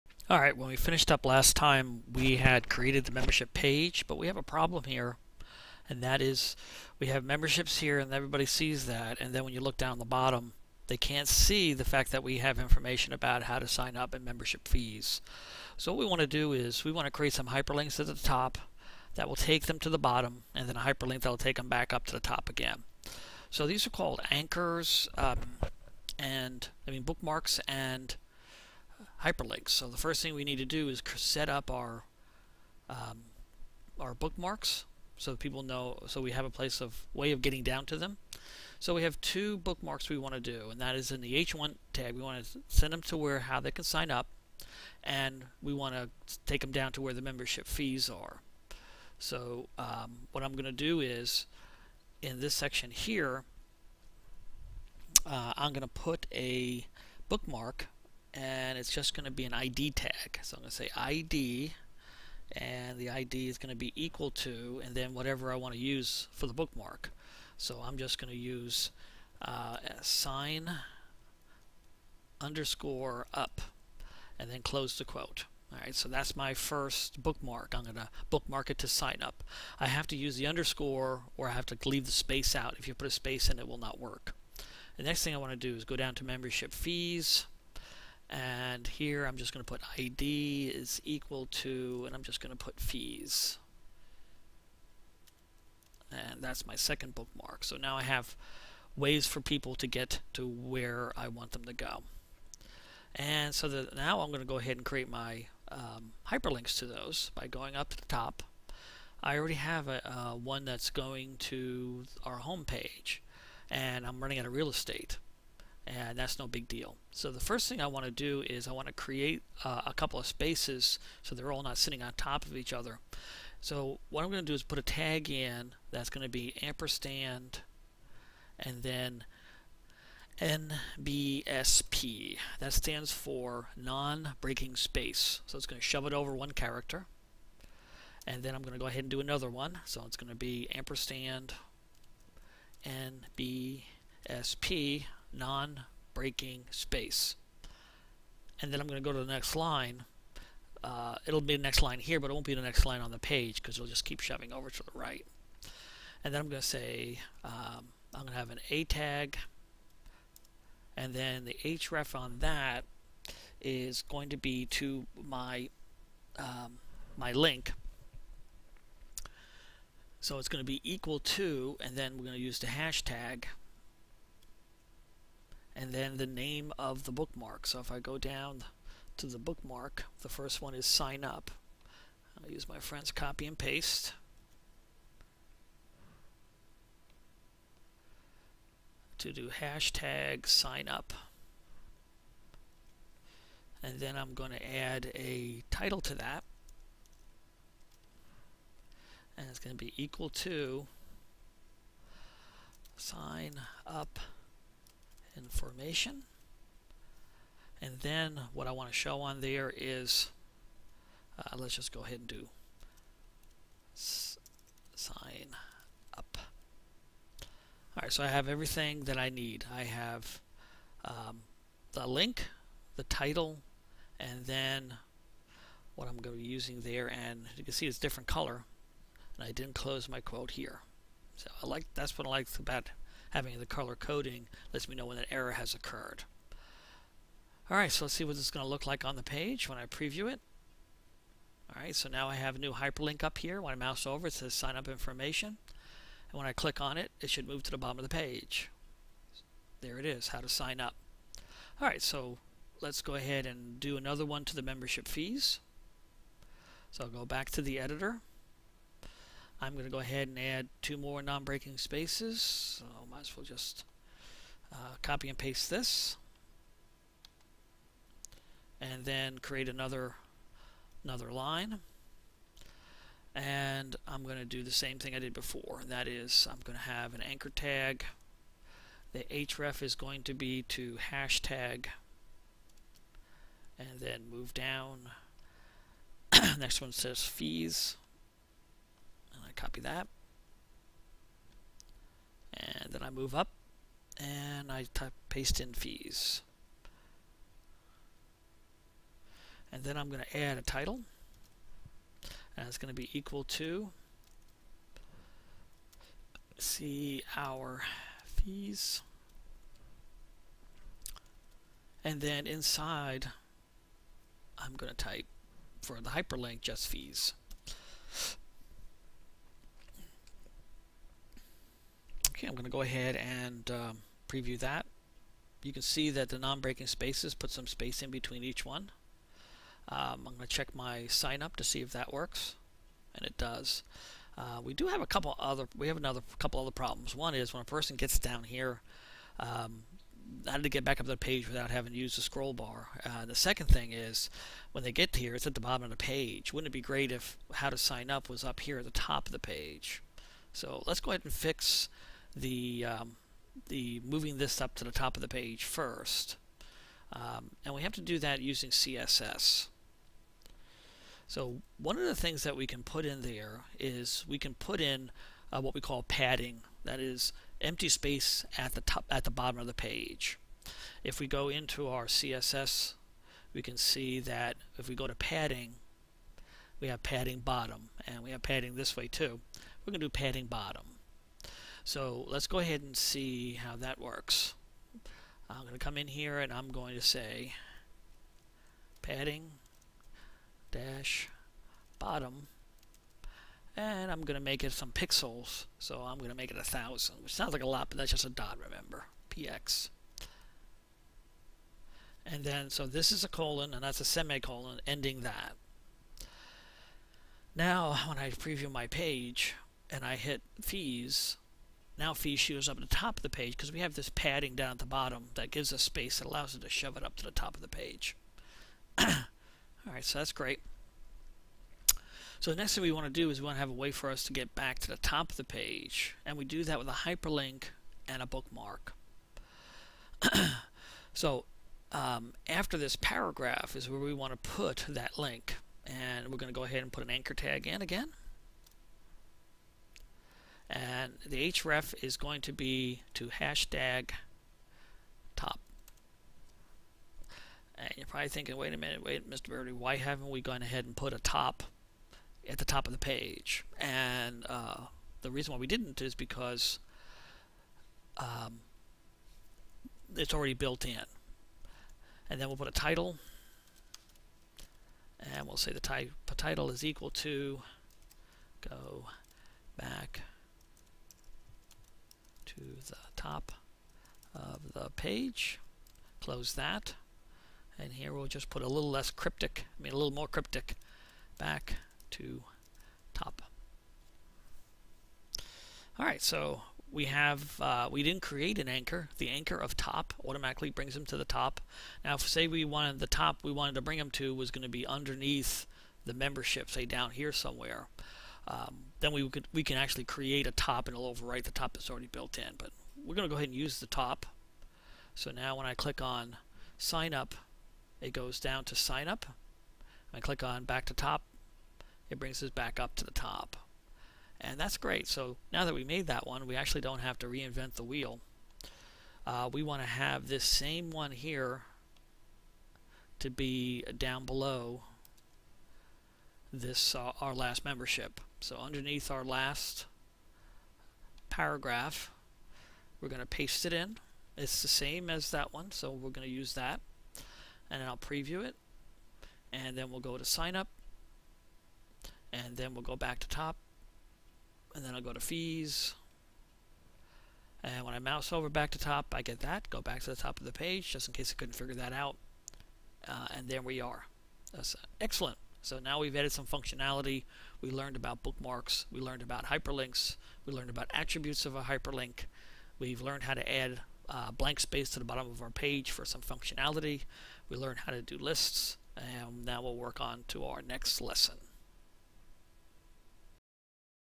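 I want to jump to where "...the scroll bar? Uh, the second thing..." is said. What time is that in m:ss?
5:42.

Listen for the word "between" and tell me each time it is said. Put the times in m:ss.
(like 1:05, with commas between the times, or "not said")
5:28.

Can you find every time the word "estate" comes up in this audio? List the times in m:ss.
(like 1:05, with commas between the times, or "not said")
1:54.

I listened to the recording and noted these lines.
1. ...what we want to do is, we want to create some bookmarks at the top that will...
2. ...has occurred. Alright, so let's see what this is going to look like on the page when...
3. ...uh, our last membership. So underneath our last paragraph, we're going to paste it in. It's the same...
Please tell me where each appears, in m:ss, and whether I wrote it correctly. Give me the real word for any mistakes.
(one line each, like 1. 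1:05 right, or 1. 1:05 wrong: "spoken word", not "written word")
1. 0:15 wrong: "hyperlinks", not "bookmarks"
2. 3:55 right
3. 8:46 right.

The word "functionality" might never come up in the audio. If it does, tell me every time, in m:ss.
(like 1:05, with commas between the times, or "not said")
9:16, 9:26.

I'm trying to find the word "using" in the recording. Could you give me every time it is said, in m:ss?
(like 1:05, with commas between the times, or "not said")
3:46, 5:58.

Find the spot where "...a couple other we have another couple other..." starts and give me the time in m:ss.
5:35.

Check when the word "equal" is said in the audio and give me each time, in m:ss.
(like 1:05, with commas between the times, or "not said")
1:03, 1:31, 2:50, 3:19, 5:03, 7:46.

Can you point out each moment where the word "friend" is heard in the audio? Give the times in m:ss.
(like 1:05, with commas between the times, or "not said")
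3:02.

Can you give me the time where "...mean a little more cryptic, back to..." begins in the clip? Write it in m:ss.
7:59.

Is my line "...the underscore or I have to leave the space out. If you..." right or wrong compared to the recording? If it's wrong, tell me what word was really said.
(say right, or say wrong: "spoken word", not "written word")
right.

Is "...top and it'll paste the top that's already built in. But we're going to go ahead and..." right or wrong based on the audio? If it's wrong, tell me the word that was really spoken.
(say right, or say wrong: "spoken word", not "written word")
wrong: "overwrite", not "paste".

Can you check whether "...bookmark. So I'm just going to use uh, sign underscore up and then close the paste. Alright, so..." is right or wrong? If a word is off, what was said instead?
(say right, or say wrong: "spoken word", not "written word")
wrong: "quote", not "paste".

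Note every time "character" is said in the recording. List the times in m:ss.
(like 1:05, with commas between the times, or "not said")
2:16.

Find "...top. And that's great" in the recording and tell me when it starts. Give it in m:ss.
8:33.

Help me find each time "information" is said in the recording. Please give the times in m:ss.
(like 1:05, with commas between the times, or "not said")
0:12, 3:25, 4:04.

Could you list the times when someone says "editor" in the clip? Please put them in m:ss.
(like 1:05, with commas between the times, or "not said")
4:17.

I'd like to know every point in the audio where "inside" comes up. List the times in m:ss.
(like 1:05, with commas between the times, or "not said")
5:12.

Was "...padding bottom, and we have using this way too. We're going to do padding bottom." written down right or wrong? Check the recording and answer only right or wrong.
wrong.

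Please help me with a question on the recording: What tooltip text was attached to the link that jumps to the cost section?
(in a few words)
see our fees.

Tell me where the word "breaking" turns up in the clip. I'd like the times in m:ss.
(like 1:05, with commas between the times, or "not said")
2:13, 2:25, 4:21, 5:26.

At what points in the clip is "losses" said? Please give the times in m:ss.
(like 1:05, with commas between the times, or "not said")
not said.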